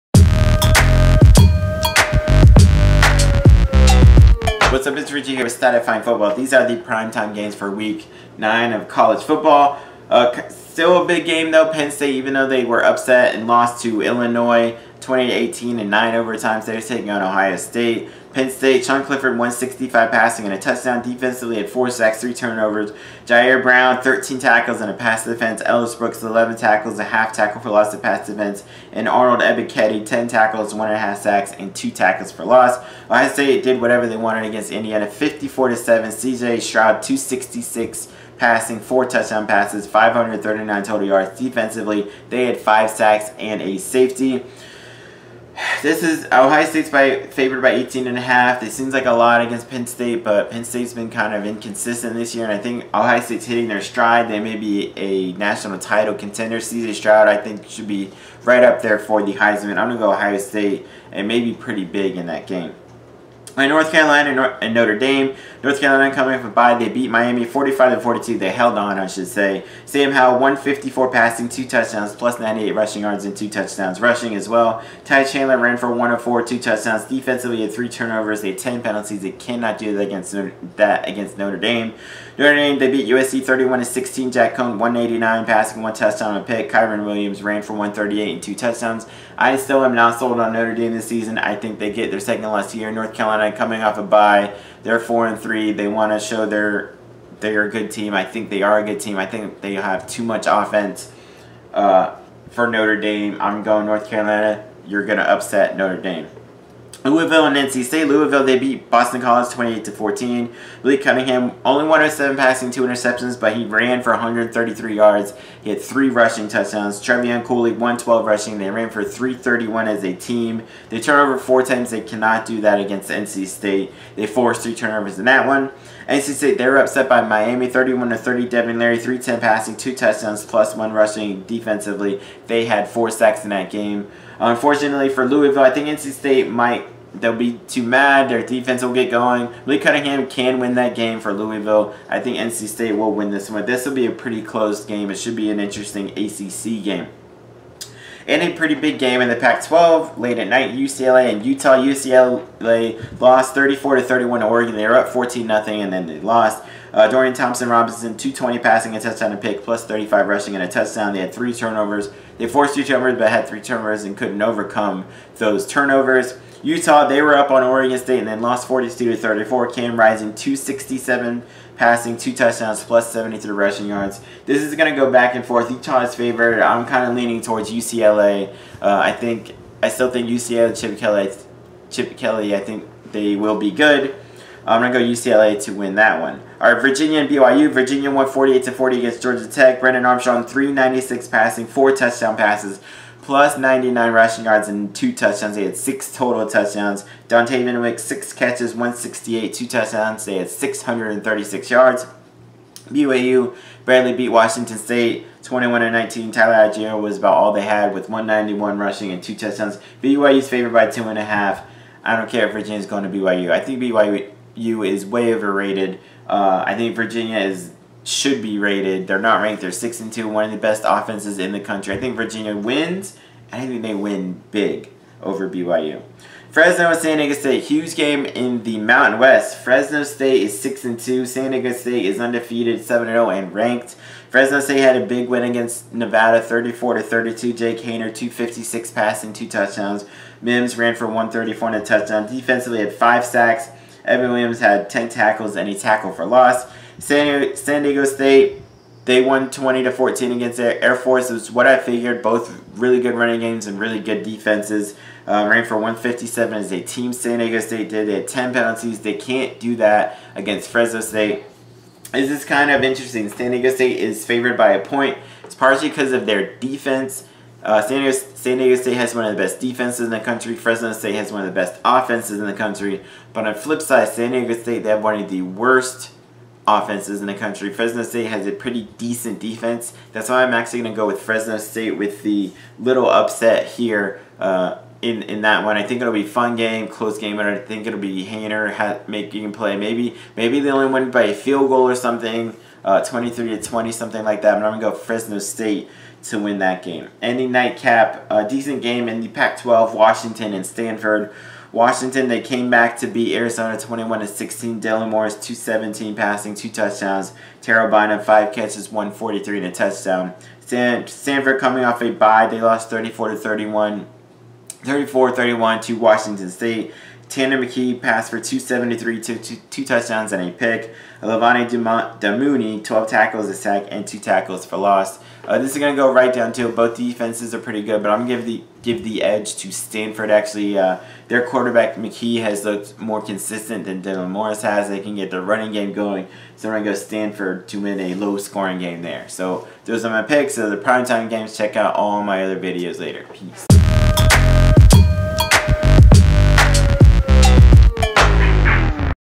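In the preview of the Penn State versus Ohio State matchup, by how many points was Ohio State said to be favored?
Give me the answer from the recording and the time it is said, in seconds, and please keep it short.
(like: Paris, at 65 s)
18.5, at 47 s.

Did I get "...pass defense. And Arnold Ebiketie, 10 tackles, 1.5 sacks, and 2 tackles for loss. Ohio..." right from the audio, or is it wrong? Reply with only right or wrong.
right.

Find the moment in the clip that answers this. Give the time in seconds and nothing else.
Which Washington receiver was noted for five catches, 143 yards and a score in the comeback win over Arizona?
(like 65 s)
307 s.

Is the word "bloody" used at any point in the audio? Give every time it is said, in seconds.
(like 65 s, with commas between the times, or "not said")
not said.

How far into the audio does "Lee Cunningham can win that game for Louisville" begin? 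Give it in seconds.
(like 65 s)
139 s.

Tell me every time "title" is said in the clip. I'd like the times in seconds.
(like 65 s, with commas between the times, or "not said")
55 s.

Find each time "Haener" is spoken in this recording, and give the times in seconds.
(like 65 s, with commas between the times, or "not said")
237 s, 288 s.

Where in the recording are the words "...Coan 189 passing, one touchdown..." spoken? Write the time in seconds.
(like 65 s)
84 s.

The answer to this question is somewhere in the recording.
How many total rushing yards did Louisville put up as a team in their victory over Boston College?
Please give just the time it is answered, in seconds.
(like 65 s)
119 s.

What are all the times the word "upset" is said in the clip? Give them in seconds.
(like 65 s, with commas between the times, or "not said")
12 s, 105 s, 126 s, 283 s.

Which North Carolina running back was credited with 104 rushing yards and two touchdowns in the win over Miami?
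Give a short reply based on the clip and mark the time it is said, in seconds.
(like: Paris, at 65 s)
Ty Chandler, at 75 s.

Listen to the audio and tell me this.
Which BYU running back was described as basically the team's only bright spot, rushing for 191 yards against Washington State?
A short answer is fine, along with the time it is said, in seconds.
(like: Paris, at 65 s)
Tyler Allgeier, at 206 s.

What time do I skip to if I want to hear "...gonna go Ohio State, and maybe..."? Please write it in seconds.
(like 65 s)
59 s.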